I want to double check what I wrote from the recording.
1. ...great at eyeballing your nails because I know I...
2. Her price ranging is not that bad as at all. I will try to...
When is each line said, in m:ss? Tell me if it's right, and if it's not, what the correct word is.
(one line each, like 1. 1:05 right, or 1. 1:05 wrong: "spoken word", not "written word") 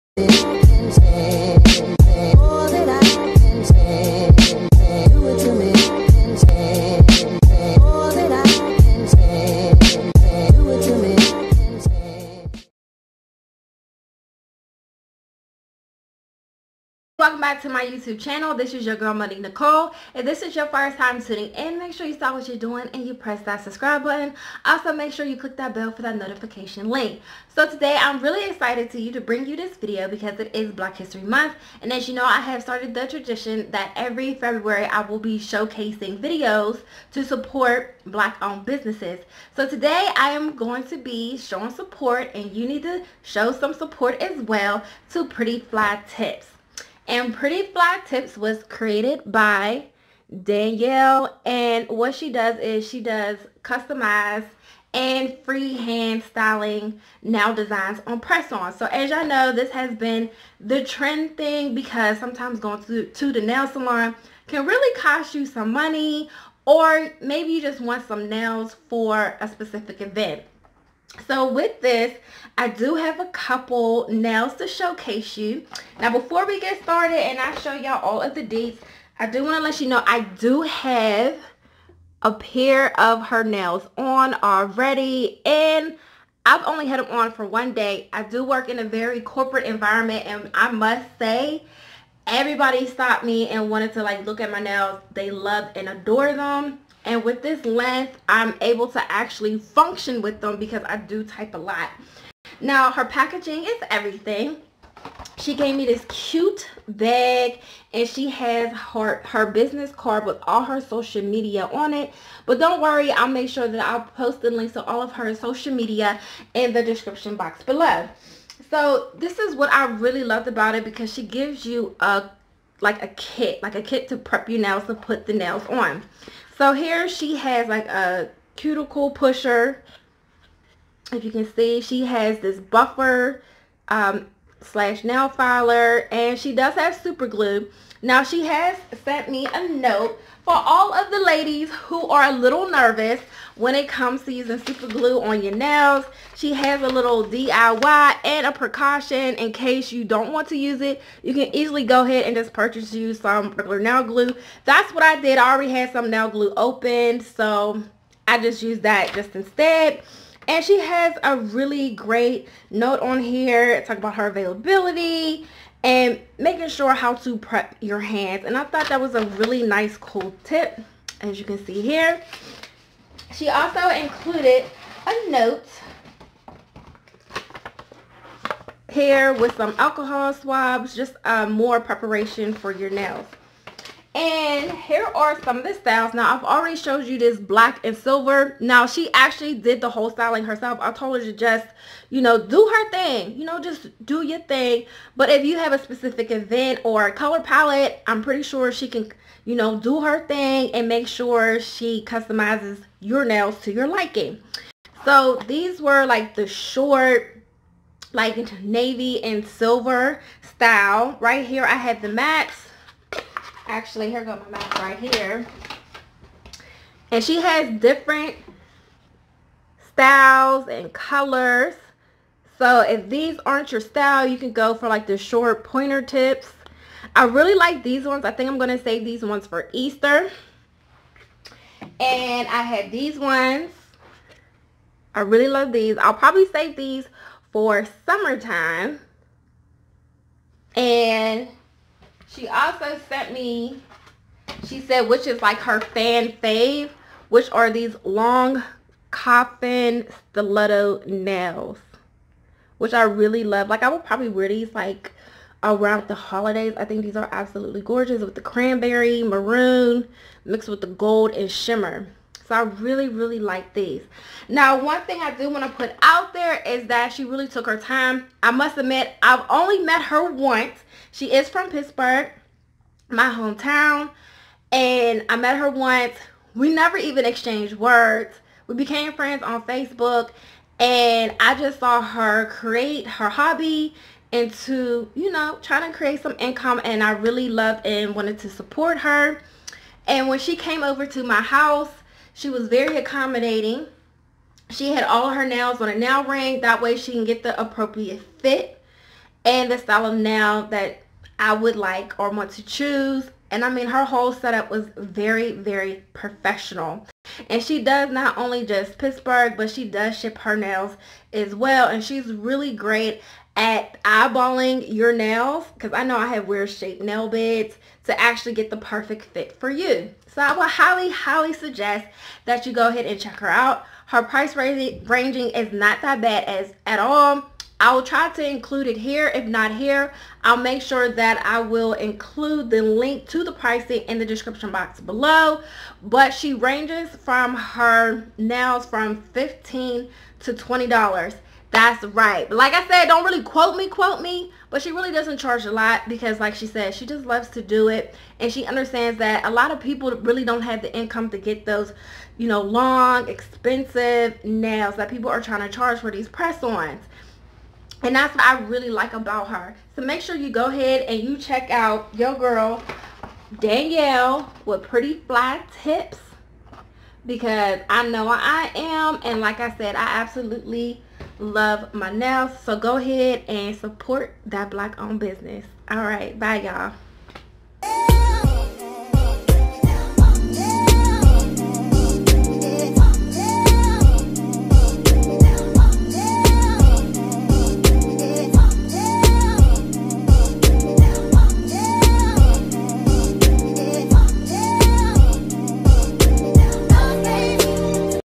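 1. 5:12 right
2. 5:24 right.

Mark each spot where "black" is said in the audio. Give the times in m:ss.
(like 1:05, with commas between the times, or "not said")
0:30, 0:38, 3:07, 6:14.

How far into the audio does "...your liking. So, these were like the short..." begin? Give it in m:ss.
3:23.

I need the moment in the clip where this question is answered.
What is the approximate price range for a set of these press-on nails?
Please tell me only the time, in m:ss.
5:39.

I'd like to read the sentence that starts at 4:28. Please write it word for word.
I must admit, I've only met her once.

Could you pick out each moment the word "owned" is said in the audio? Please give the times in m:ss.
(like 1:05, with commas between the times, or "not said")
0:38, 6:15.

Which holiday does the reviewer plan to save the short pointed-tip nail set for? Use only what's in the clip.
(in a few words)
Easter.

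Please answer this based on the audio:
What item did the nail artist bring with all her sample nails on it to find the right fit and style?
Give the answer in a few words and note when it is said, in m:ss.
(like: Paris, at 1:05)
nail ring, at 4:55.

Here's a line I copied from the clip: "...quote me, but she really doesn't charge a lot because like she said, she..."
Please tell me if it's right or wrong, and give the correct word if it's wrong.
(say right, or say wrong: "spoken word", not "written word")
right.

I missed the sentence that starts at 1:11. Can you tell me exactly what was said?
So with this, I do have a couple nails to showcase you.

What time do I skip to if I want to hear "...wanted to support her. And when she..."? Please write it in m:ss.
4:48.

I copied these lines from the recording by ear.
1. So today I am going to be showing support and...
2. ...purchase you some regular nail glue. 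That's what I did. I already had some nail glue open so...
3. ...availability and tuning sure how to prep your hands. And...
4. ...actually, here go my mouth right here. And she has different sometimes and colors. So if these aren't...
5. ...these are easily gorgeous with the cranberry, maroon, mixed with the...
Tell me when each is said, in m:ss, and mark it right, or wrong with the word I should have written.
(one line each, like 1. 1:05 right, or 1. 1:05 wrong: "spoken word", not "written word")
1. 0:39 right
2. 2:32 right
3. 2:44 wrong: "making", not "tuning"
4. 3:33 wrong: "styles", not "sometimes"
5. 4:17 wrong: "absolutely", not "easily".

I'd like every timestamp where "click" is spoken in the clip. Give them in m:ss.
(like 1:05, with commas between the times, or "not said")
0:25.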